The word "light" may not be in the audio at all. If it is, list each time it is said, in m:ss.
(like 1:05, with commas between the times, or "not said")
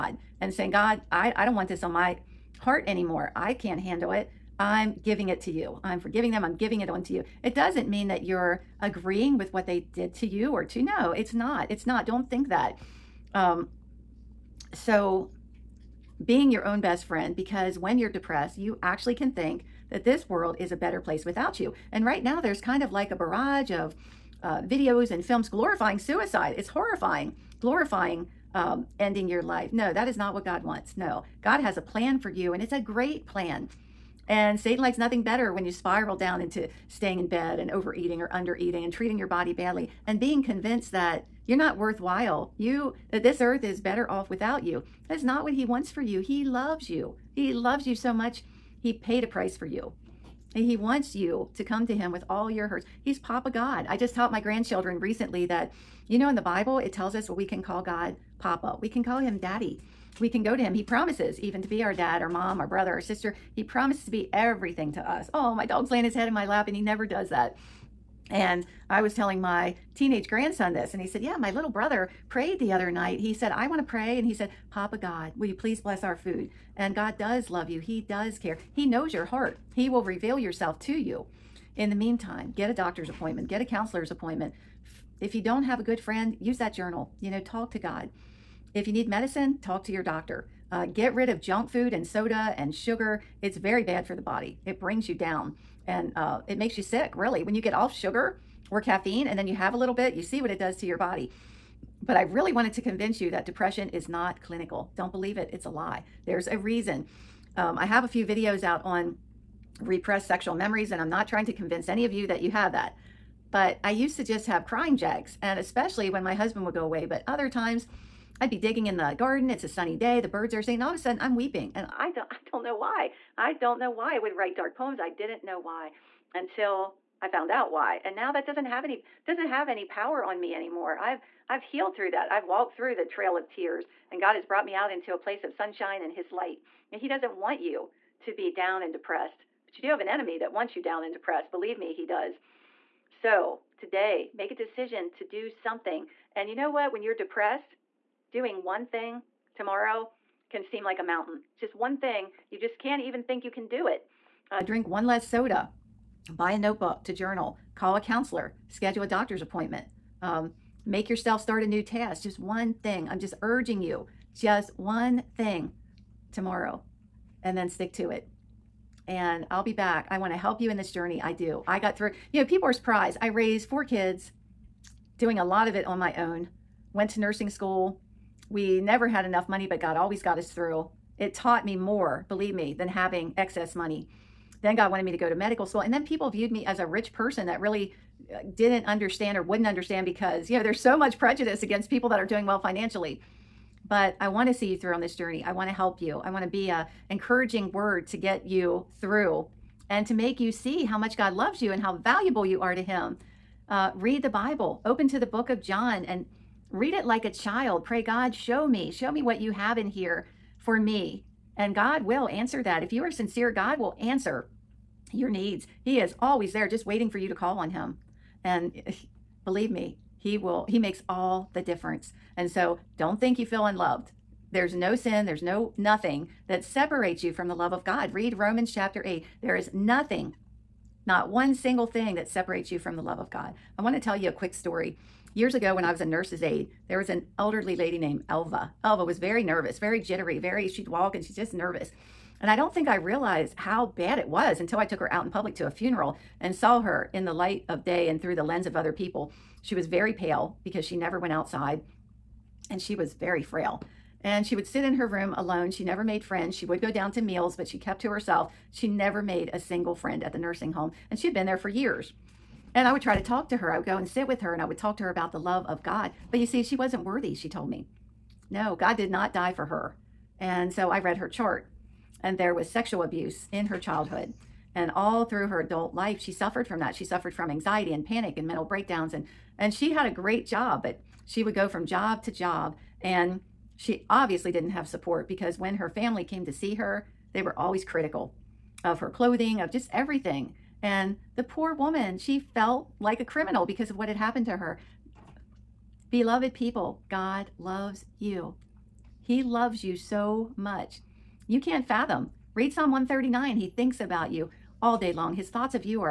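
2:16, 4:07.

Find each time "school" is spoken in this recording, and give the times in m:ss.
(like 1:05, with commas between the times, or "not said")
2:57, 3:05.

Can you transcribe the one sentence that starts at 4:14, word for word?
And she would sit in her room alone.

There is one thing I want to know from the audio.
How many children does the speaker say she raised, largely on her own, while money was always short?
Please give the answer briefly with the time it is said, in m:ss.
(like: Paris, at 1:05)
4, at 2:53.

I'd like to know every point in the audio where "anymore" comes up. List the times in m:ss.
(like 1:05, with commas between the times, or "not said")
0:02, 2:10.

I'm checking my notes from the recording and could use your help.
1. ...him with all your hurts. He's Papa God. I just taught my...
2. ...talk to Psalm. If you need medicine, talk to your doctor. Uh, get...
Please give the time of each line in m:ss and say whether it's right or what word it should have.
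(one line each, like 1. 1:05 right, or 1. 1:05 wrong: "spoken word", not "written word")
1. 0:51 right
2. 1:27 wrong: "God", not "Psalm".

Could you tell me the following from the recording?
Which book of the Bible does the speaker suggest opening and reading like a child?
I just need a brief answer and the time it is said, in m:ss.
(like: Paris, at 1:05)
John, at 3:25.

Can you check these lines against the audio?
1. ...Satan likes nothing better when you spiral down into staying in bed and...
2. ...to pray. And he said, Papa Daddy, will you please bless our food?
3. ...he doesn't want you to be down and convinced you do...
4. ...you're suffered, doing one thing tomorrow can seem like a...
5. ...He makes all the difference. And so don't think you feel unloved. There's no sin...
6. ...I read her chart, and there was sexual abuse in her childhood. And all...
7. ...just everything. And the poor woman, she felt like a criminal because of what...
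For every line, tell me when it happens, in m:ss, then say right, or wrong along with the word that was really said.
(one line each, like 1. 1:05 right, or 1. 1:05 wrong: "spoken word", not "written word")
1. 0:34 right
2. 1:13 wrong: "God", not "Daddy"
3. 2:17 wrong: "depressed", not "convinced"
4. 2:27 wrong: "depressed", not "suffered"
5. 3:40 right
6. 4:30 right
7. 4:49 right.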